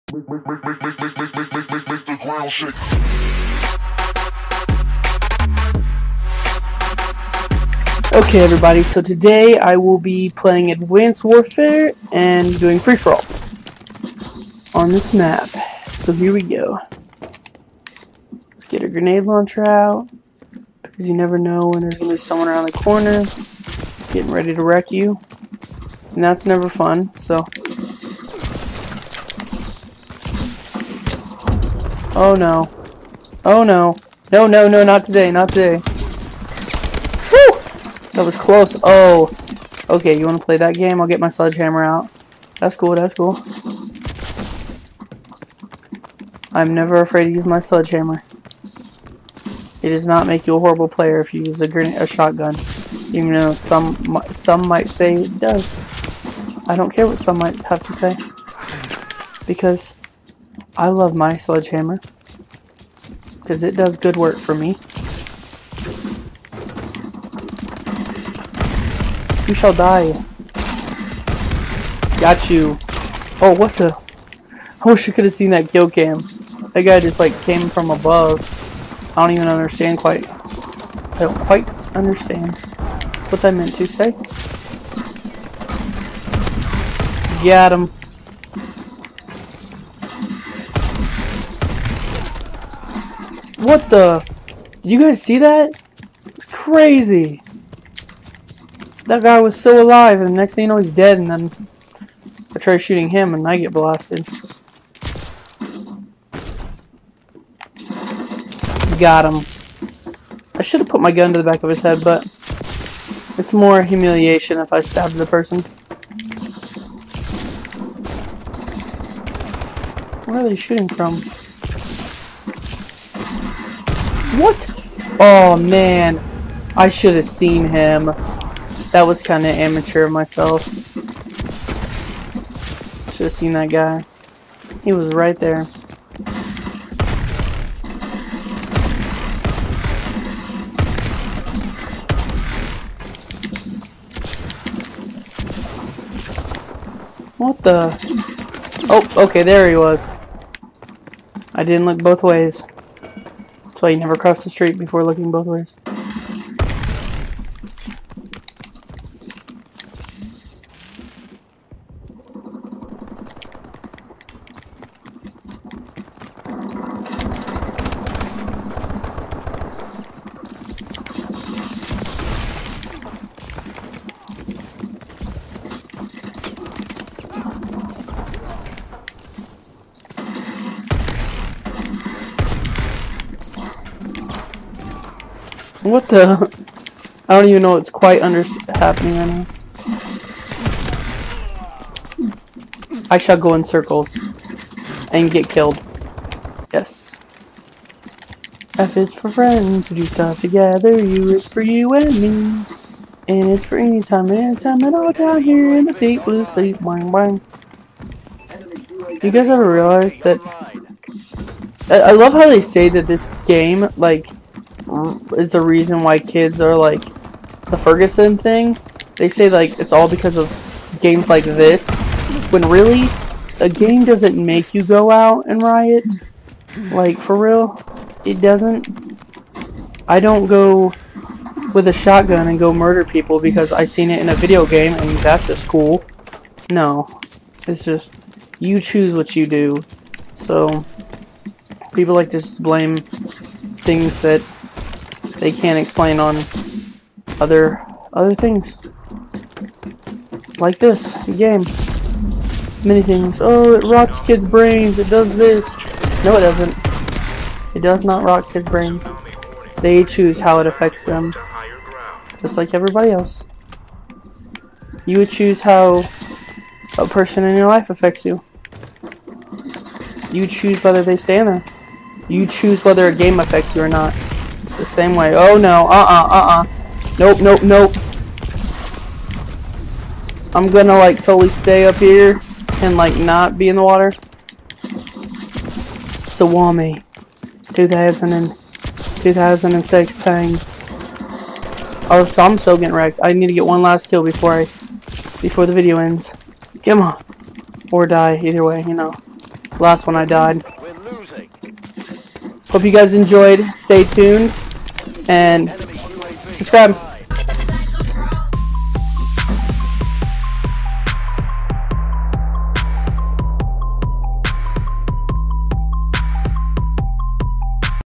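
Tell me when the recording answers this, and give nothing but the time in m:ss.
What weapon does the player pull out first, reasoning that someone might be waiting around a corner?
0:18.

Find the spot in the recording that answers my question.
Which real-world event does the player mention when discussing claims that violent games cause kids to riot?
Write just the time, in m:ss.
3:37.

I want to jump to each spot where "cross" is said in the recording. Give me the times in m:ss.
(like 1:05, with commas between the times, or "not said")
2:34.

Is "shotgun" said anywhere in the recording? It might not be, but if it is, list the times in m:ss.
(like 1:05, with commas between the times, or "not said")
0:52, 3:51.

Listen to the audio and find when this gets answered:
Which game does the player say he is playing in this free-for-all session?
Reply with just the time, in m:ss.
0:10.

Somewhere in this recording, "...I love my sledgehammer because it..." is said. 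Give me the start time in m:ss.
1:00.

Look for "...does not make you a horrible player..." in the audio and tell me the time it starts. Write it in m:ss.
0:49.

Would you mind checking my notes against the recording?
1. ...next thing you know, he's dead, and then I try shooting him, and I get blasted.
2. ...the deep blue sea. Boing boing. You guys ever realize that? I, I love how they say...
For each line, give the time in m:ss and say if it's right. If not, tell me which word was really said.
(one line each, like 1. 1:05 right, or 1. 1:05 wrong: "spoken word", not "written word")
1. 1:40 right
2. 3:25 right.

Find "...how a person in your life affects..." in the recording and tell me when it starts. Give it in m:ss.
4:25.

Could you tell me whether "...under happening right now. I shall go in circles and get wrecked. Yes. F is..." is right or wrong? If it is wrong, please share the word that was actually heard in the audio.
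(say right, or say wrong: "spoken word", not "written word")
wrong: "killed", not "wrecked".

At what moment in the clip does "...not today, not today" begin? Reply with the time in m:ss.
0:34.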